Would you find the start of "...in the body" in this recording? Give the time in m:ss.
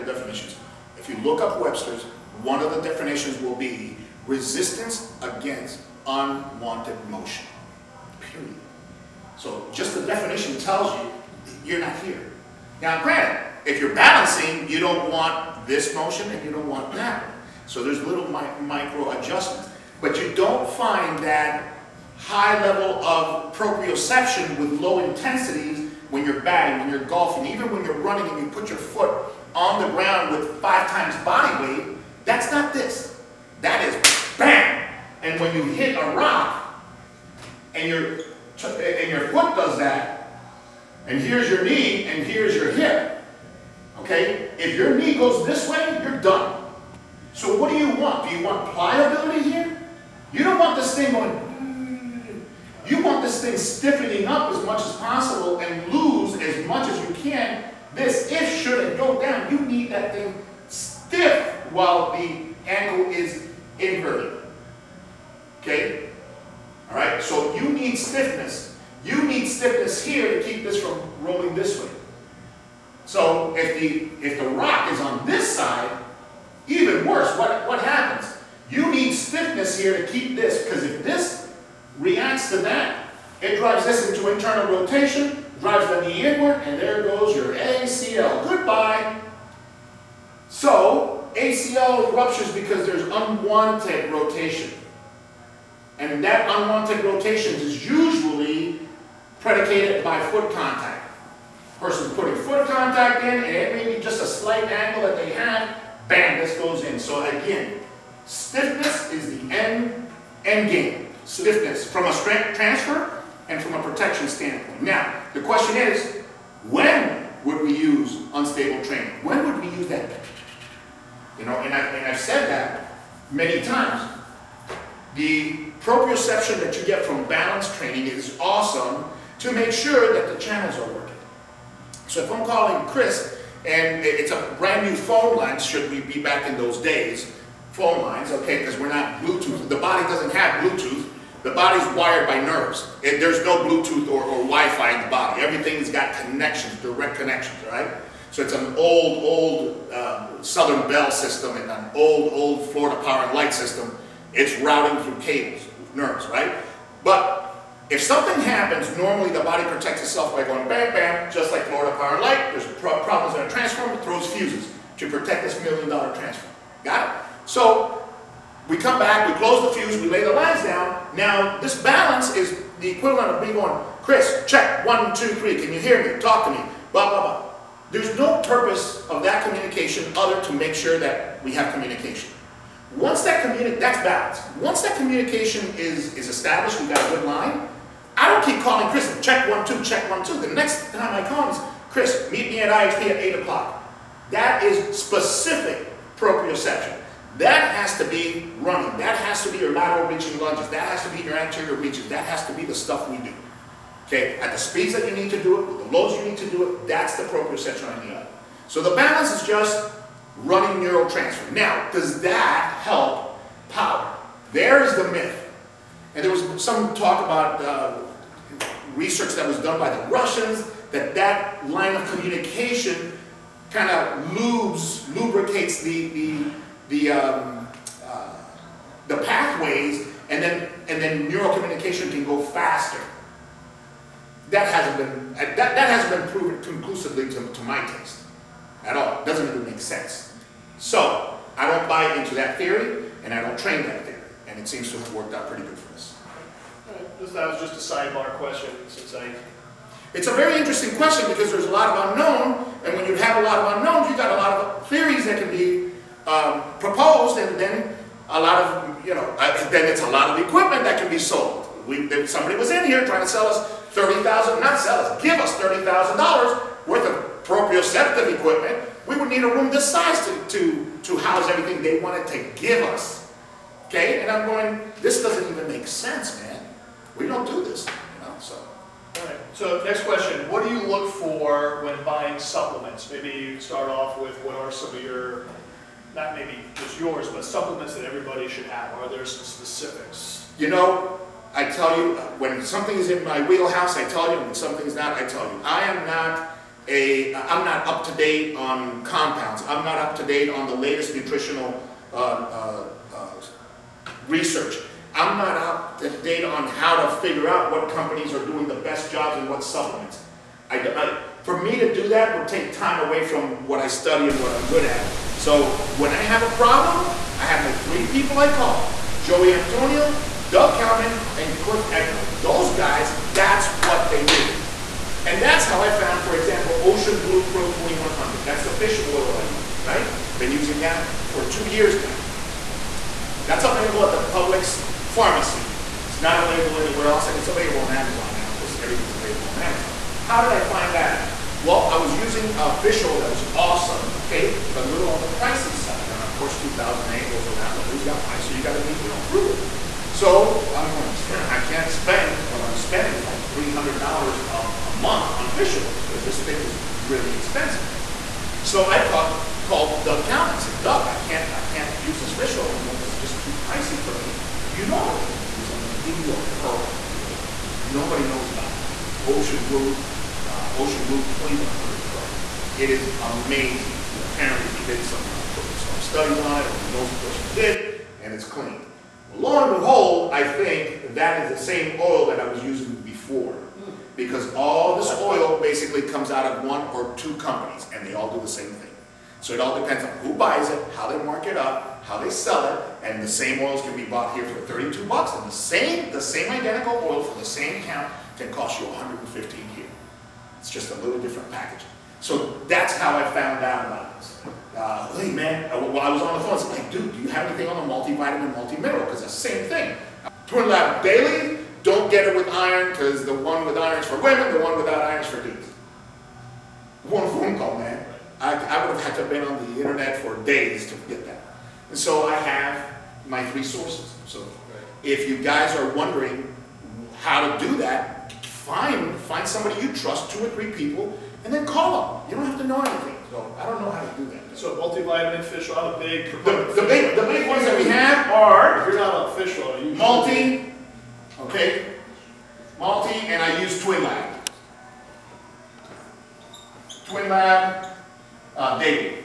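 2:24.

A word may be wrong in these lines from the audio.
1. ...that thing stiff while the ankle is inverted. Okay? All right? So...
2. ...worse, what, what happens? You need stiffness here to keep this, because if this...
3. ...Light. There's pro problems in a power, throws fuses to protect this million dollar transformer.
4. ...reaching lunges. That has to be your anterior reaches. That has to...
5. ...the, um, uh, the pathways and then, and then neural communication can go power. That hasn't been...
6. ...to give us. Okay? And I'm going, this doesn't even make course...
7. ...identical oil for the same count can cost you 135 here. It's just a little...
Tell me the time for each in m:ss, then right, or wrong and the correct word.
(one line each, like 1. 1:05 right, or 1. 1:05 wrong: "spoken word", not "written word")
1. 0:59 right
2. 1:17 right
3. 2:42 wrong: "transformer", not "power"
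4. 3:20 right
5. 3:46 wrong: "faster", not "power"
6. 4:32 wrong: "sense", not "course"
7. 6:36 wrong: "115", not "135".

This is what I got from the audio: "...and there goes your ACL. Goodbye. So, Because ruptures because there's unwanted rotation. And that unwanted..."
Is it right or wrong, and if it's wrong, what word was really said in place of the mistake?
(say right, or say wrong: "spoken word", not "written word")
wrong: "ACL", not "Because".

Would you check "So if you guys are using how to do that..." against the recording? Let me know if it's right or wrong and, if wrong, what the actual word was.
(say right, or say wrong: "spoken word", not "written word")
wrong: "wondering", not "using".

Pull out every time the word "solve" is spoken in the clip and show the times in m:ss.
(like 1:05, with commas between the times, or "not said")
not said.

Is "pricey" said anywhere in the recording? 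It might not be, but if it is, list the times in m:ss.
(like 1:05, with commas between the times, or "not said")
5:45, 6:03.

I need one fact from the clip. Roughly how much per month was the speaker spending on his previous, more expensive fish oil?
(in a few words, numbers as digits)
$300.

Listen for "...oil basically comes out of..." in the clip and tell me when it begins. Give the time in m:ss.
6:25.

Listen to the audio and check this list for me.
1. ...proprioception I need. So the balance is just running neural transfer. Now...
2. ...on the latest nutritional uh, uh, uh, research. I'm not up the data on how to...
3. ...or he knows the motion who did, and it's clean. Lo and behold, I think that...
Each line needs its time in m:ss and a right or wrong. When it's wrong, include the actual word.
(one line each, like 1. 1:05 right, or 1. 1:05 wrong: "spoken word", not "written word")
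1. 3:27 right
2. 5:00 right
3. 6:16 wrong: "person", not "motion".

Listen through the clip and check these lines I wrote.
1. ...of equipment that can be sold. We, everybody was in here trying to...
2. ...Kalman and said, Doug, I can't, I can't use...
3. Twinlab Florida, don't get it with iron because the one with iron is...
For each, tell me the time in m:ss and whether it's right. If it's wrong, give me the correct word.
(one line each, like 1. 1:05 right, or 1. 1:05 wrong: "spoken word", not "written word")
1. 4:20 wrong: "somebody", not "everybody"
2. 6:00 right
3. 6:50 wrong: "Daily", not "Florida".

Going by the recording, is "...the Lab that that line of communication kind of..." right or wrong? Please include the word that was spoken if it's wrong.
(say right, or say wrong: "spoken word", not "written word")
wrong: "Russians", not "Lab".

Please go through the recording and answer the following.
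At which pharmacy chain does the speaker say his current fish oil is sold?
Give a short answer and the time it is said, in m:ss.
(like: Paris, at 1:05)
Publix, at 5:34.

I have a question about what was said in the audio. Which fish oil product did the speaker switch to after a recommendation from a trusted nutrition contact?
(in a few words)
Ocean Blue Pro 2100.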